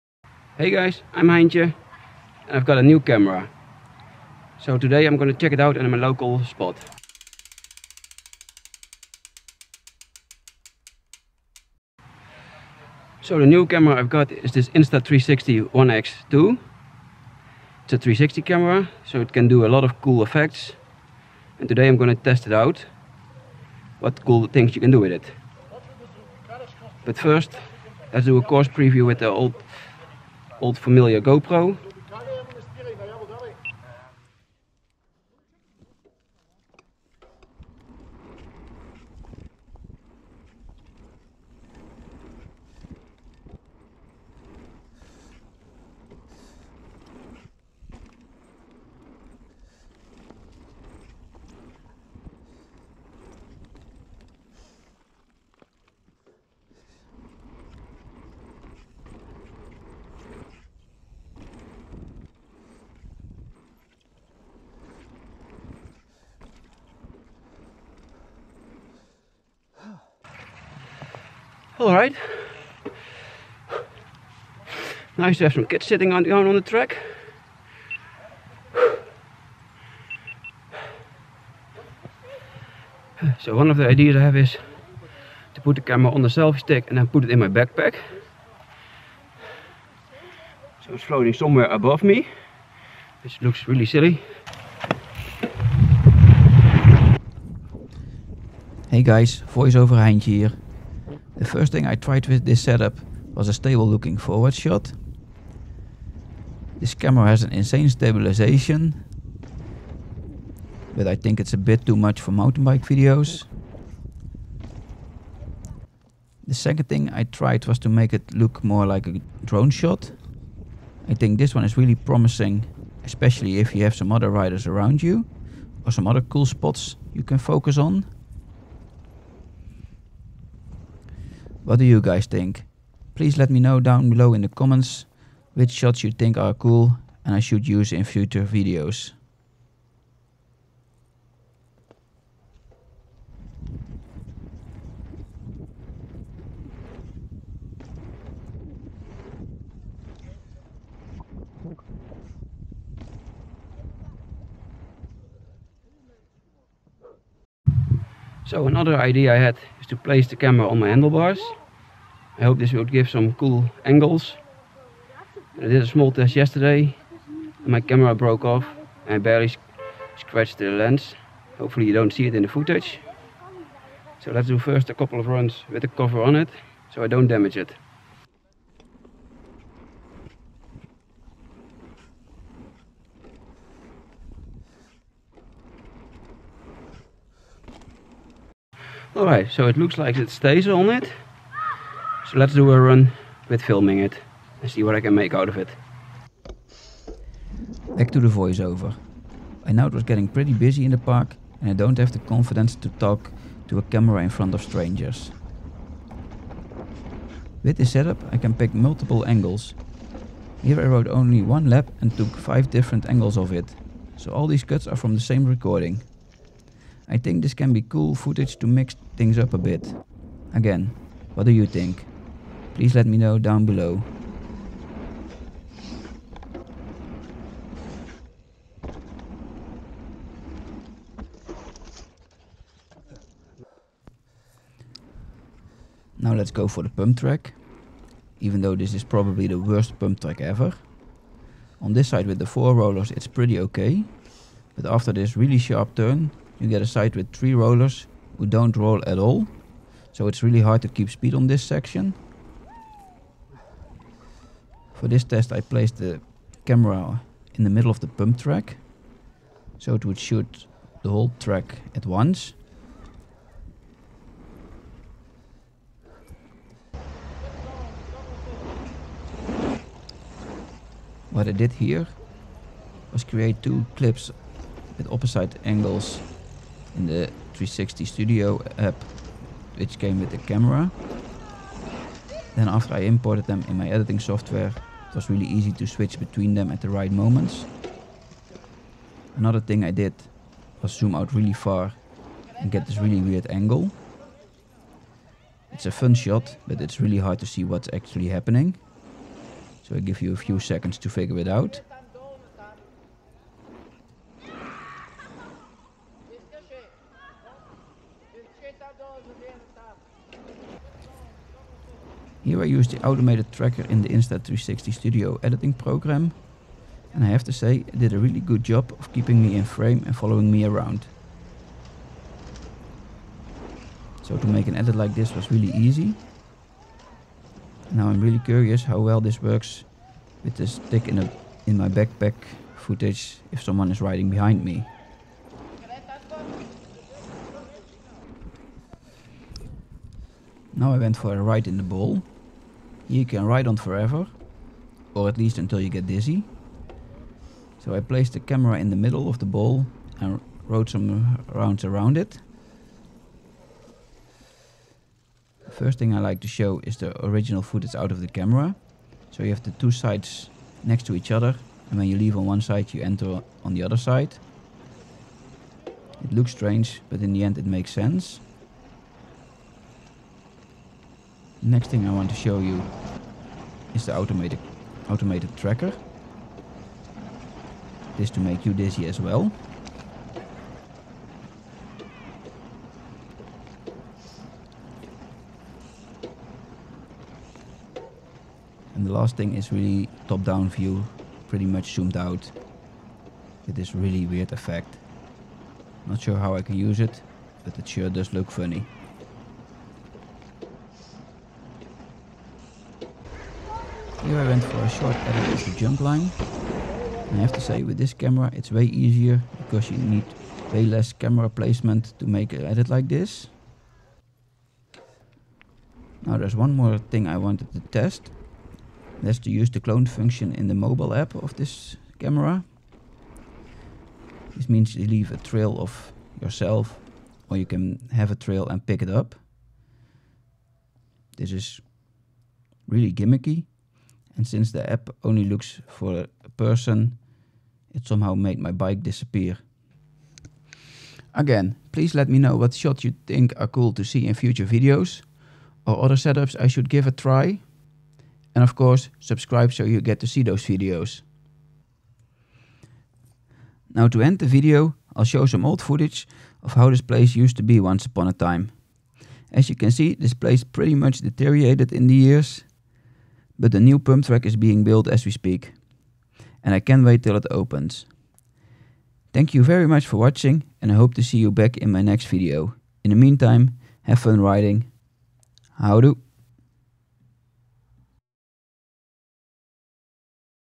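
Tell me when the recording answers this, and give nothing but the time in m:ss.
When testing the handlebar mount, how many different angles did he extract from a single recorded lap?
3:32.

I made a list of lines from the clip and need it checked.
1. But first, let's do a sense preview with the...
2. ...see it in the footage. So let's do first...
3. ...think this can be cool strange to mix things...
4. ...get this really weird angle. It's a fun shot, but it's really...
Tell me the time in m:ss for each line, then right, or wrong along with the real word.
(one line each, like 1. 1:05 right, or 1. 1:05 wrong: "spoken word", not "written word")
1. 0:27 wrong: "course", not "sense"
2. 2:52 right
3. 3:37 wrong: "footage", not "strange"
4. 4:52 right.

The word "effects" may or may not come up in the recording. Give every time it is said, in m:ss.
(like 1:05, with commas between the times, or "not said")
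0:20, 6:34.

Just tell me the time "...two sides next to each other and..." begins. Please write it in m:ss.
5:59.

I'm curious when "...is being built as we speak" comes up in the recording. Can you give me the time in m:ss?
7:44.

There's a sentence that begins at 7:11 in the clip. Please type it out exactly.
This is really gimmicky, and since the app only looks for a person, it somehow made my bike disappear.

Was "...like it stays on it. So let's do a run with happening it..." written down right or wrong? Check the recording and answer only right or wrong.
wrong.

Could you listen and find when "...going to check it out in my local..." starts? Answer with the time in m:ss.
0:05.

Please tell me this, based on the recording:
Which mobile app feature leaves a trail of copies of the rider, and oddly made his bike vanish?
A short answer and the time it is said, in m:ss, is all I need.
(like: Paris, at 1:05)
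clone function, at 6:59.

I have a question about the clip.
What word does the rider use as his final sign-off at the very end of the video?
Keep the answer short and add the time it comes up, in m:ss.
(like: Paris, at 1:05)
Houdoe, at 7:55.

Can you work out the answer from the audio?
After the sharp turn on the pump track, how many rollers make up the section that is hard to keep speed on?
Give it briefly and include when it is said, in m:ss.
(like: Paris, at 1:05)
3, at 4:07.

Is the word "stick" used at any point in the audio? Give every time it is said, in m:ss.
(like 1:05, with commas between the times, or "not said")
1:26, 5:30.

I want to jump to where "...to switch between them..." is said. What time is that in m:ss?
4:45.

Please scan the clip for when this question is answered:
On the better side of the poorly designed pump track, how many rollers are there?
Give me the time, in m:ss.
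4:02.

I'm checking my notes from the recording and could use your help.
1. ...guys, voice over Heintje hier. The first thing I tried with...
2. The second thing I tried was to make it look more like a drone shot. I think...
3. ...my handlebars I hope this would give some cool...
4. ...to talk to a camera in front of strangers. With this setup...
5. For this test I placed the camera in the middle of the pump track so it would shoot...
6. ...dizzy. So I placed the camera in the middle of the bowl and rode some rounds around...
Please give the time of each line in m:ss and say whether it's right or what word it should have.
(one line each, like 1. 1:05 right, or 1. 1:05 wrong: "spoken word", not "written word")
1. 1:39 right
2. 1:56 right
3. 2:40 right
4. 3:22 right
5. 4:15 right
6. 5:46 right.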